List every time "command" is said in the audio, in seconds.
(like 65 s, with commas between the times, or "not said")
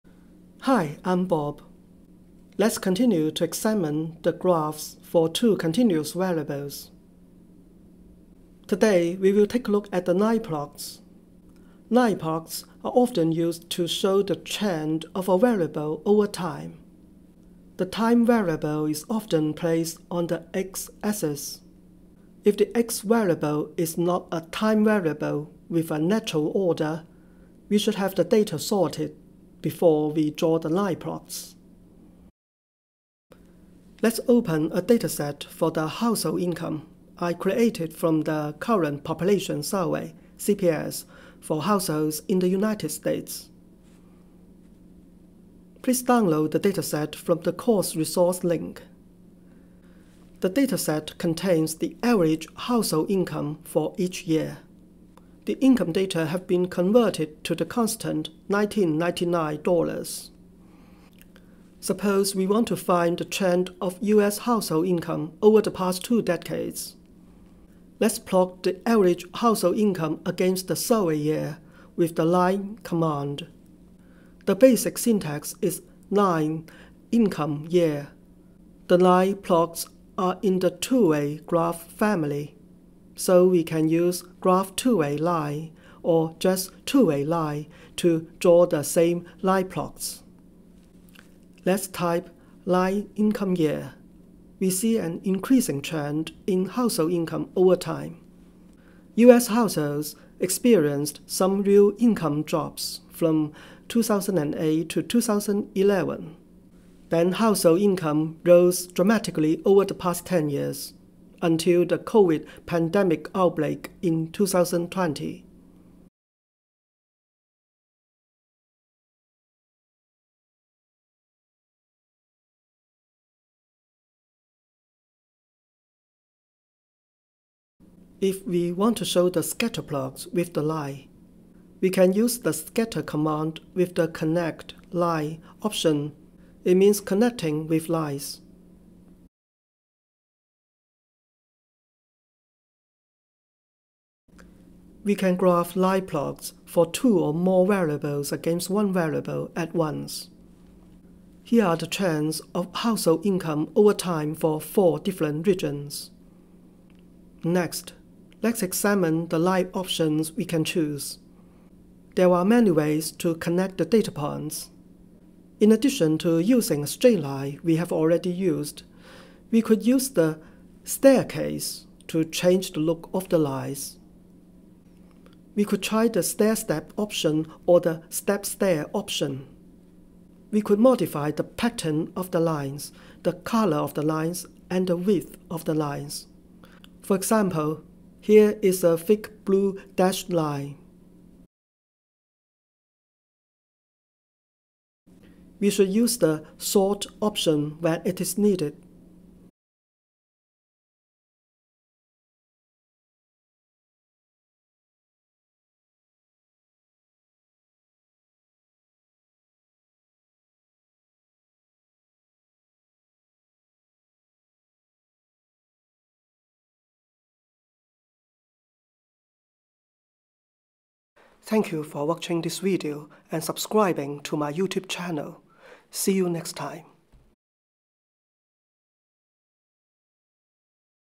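72 s, 133 s.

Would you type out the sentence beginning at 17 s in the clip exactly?
The time variable is often placed on the x-axis.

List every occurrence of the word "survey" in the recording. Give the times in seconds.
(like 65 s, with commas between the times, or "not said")
39 s, 70 s.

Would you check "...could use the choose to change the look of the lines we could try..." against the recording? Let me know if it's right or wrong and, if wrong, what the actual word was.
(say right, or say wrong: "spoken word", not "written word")
wrong: "staircase", not "choose".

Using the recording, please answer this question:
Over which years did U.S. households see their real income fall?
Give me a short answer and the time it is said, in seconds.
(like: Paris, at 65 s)
2008 to 2011, at 103 s.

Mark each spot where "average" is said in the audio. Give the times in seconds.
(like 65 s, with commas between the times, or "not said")
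52 s, 68 s.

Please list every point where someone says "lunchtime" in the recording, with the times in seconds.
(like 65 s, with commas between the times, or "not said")
not said.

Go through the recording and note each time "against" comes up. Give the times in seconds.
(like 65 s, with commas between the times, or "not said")
70 s, 148 s.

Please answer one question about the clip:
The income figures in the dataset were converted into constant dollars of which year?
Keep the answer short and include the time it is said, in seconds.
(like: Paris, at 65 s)
1999, at 58 s.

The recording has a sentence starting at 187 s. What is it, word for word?
For example, here is a thick blue dashed line.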